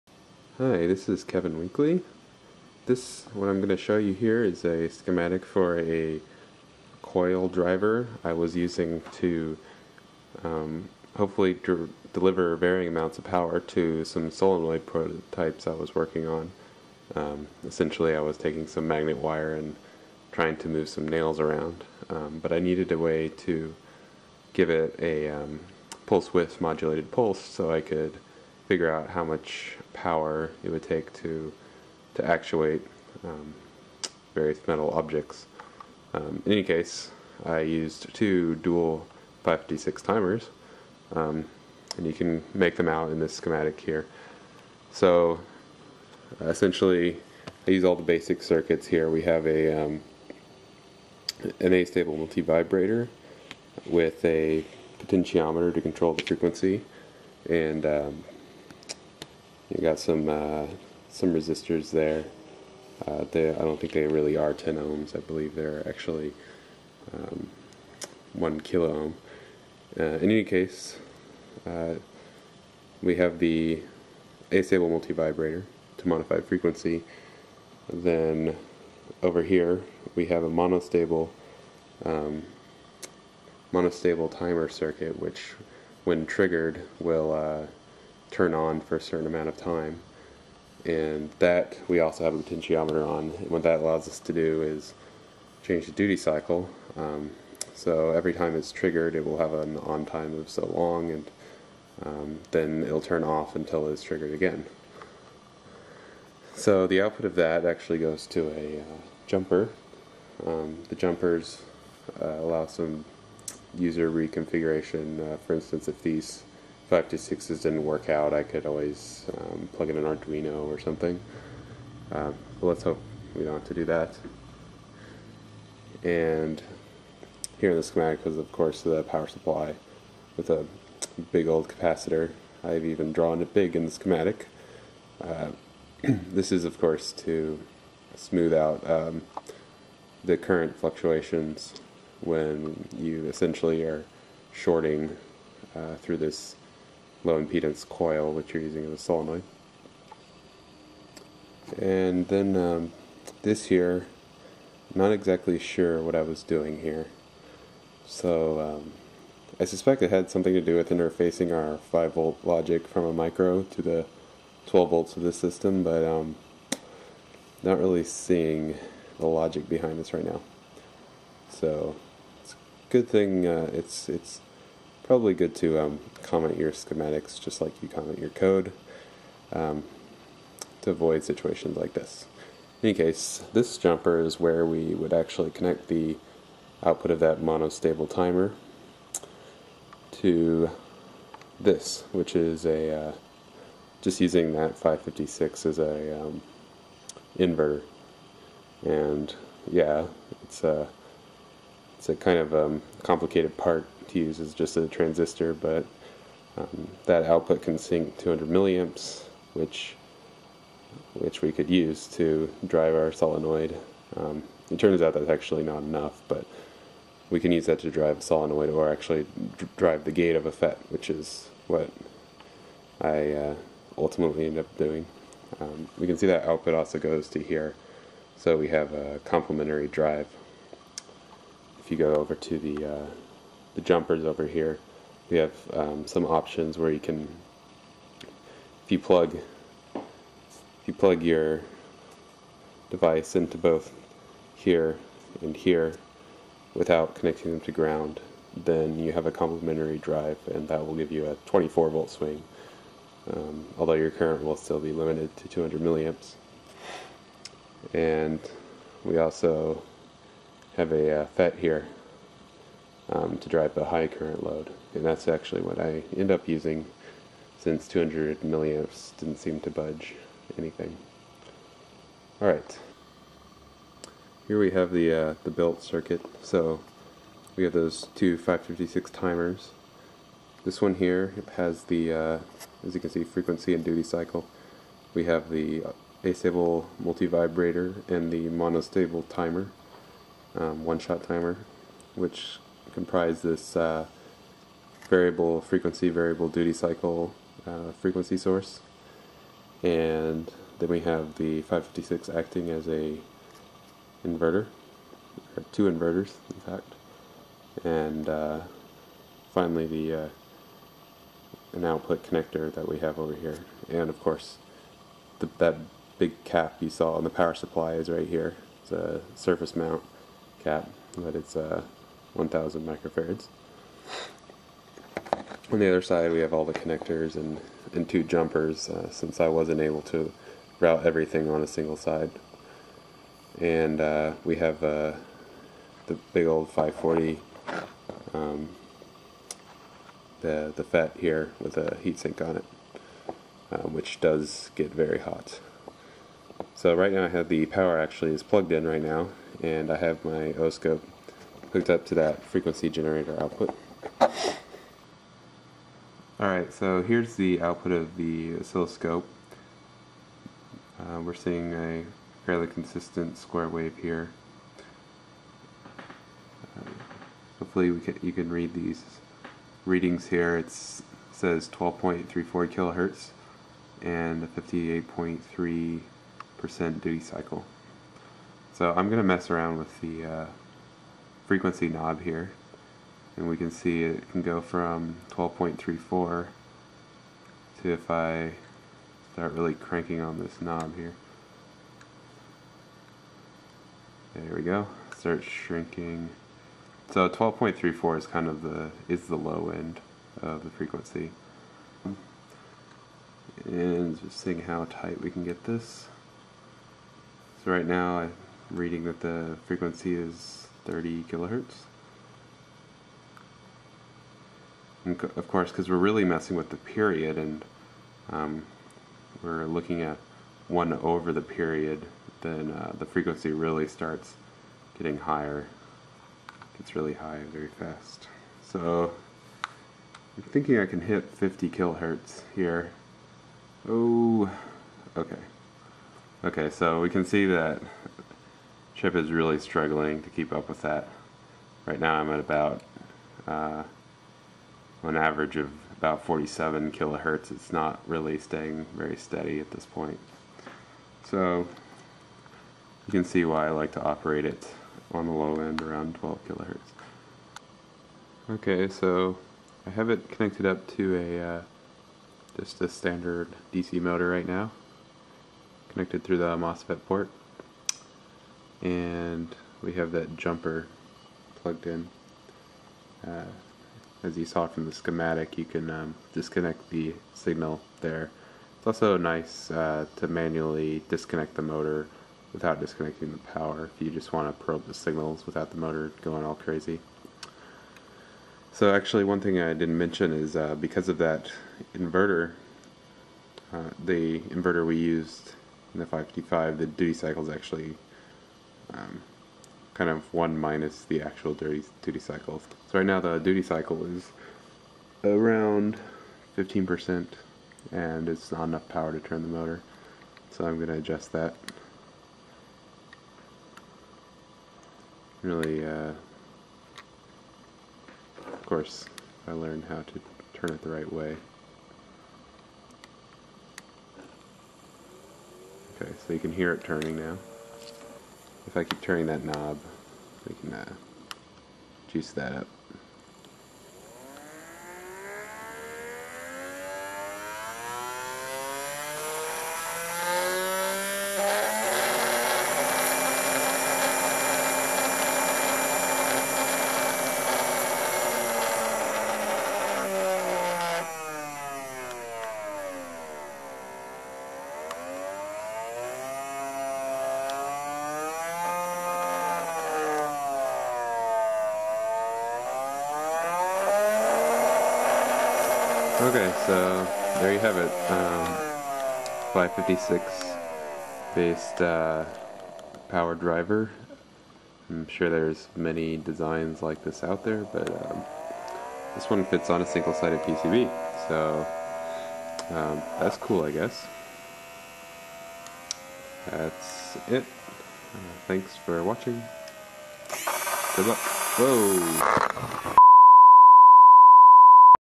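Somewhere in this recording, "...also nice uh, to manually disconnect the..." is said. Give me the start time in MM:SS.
07:58.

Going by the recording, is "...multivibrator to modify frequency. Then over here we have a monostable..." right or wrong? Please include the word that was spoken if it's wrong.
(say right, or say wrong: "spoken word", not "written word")
right.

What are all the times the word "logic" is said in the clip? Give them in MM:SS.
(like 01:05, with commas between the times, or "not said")
02:42, 02:49.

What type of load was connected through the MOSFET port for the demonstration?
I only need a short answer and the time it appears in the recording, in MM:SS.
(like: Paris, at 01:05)
DC motor, at 07:43.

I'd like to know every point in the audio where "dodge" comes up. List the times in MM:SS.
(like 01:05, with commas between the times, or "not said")
not said.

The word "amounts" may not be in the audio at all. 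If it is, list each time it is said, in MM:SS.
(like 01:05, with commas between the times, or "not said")
00:12, 01:29.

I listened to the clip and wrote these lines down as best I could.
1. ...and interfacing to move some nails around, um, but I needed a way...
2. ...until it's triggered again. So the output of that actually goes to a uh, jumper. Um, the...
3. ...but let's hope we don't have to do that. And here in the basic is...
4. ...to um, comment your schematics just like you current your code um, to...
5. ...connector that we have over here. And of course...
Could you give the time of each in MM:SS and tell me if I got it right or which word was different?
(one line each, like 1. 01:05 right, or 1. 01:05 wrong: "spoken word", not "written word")
1. 00:19 wrong: "trying", not "interfacing"
2. 01:43 right
3. 02:02 wrong: "schematic", not "basic"
4. 02:55 wrong: "comment", not "current"
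5. 05:12 right.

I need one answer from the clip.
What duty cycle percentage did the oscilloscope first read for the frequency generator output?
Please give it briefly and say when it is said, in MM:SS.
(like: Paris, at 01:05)
58.3%, at 06:14.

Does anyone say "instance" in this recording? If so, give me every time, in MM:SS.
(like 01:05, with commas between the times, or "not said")
01:55.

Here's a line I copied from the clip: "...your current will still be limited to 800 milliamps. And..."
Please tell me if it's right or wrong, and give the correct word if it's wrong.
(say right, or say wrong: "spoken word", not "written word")
wrong: "200", not "800".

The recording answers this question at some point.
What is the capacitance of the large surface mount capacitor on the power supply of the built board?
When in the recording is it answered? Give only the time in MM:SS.
05:22.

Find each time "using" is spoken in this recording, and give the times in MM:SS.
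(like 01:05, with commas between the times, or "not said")
00:08, 02:28, 03:14, 04:26.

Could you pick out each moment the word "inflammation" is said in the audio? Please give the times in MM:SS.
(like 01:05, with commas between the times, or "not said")
not said.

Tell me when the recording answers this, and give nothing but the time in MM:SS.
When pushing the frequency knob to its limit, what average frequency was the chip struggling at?
07:26.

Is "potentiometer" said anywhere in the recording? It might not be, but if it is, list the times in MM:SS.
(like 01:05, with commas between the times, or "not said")
00:55, 01:32.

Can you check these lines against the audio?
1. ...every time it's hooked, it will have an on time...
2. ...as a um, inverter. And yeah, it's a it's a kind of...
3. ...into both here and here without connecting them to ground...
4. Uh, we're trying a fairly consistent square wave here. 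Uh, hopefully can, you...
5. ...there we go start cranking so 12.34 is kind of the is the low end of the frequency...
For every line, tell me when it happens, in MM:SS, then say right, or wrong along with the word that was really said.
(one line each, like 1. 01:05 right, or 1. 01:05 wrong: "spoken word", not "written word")
1. 01:38 wrong: "triggered", not "hooked"
2. 03:15 right
3. 04:03 right
4. 06:00 wrong: "seeing", not "trying"
5. 06:34 wrong: "shrinking", not "cranking".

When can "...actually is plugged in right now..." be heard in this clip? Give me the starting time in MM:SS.
05:47.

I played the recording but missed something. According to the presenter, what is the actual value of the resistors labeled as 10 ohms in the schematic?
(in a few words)
1 kilo ohm.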